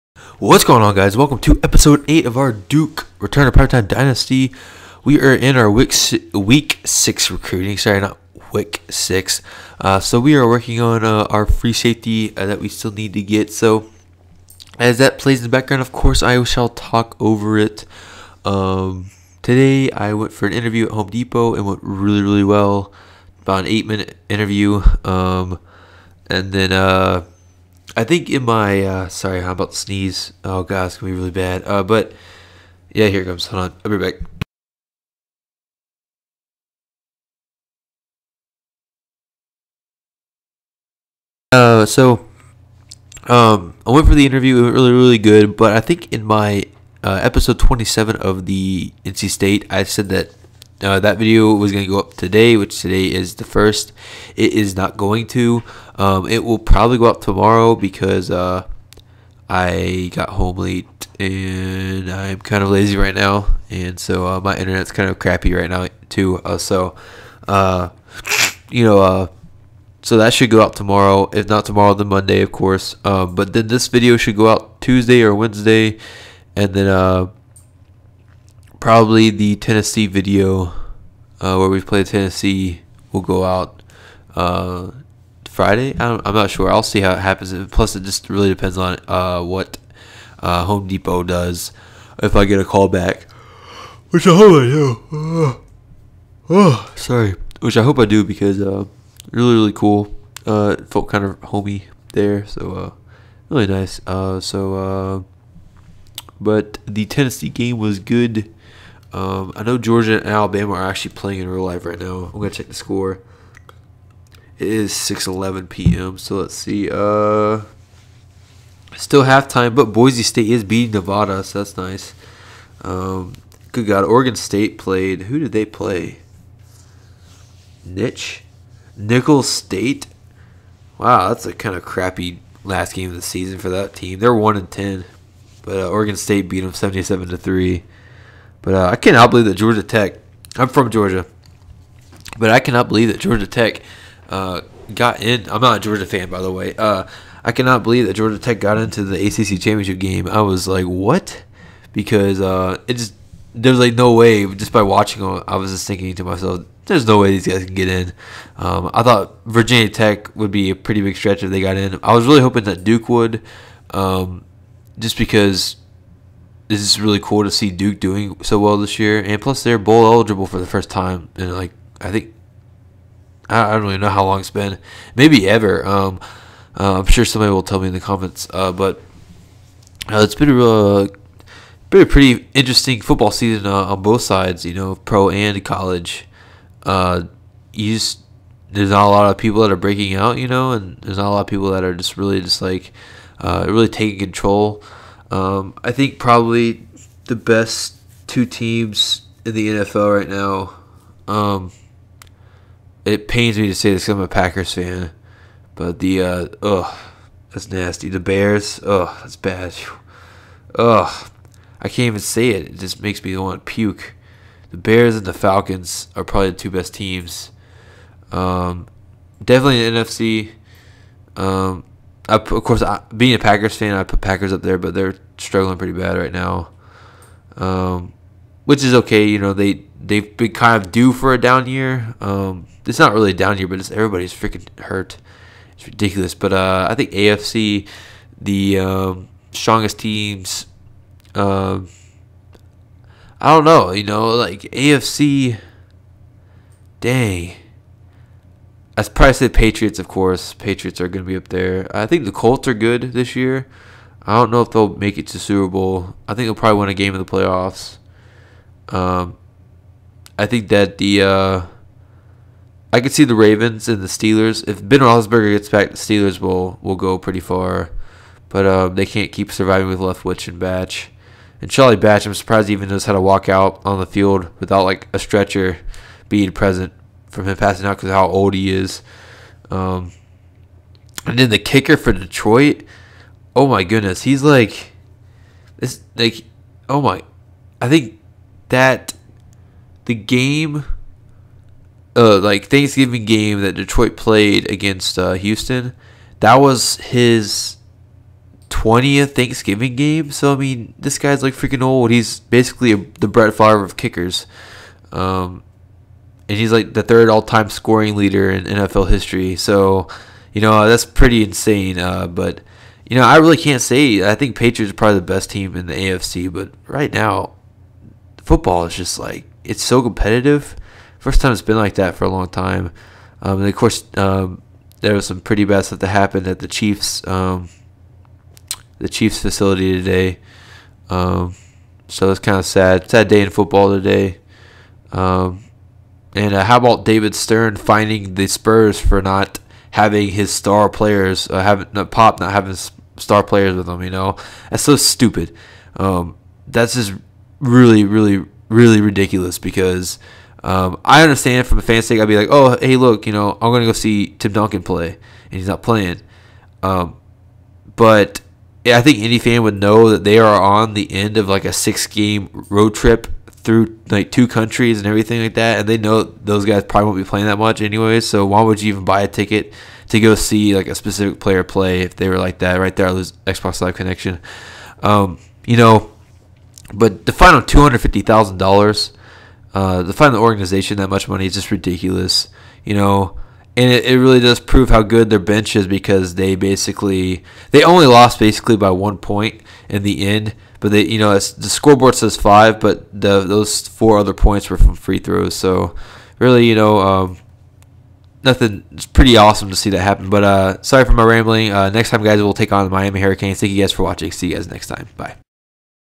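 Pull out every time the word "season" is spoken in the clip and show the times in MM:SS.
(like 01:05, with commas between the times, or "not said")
02:13, 03:03.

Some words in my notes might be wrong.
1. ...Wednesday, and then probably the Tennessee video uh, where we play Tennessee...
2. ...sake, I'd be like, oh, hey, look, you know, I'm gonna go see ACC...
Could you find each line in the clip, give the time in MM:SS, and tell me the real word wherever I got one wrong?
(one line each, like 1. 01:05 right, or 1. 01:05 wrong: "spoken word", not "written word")
1. 01:15 right
2. 05:52 wrong: "Tim", not "ACC".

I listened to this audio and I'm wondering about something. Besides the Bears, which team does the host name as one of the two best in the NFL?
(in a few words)
Falcons.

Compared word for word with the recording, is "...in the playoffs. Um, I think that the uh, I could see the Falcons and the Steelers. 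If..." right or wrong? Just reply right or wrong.
wrong.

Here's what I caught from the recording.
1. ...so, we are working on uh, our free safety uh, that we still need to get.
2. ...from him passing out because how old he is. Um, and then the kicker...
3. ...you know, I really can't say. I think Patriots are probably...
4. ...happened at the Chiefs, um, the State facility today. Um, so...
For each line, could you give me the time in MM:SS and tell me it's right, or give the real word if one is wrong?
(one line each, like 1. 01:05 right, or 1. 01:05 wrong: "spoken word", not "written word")
1. 00:09 right
2. 04:37 right
3. 05:13 right
4. 05:26 wrong: "Chiefs", not "State".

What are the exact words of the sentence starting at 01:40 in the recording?
felt kind of homey there, so really nice.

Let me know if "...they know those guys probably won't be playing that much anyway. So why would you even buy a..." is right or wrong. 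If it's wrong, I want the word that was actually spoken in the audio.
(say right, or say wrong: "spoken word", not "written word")
right.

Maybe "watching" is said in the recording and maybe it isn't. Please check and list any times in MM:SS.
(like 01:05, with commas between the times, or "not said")
02:34, 06:44.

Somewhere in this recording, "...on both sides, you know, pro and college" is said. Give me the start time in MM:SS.
03:03.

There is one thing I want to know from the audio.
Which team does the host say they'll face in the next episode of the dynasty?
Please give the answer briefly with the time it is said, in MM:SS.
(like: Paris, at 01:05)
Miami Hurricanes, at 06:42.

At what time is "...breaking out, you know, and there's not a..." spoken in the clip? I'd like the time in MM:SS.
03:09.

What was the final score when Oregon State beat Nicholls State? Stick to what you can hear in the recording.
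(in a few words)
77 to 3.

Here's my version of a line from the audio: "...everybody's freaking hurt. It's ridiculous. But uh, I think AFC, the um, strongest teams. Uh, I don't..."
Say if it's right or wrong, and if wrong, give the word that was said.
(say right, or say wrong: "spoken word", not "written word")
right.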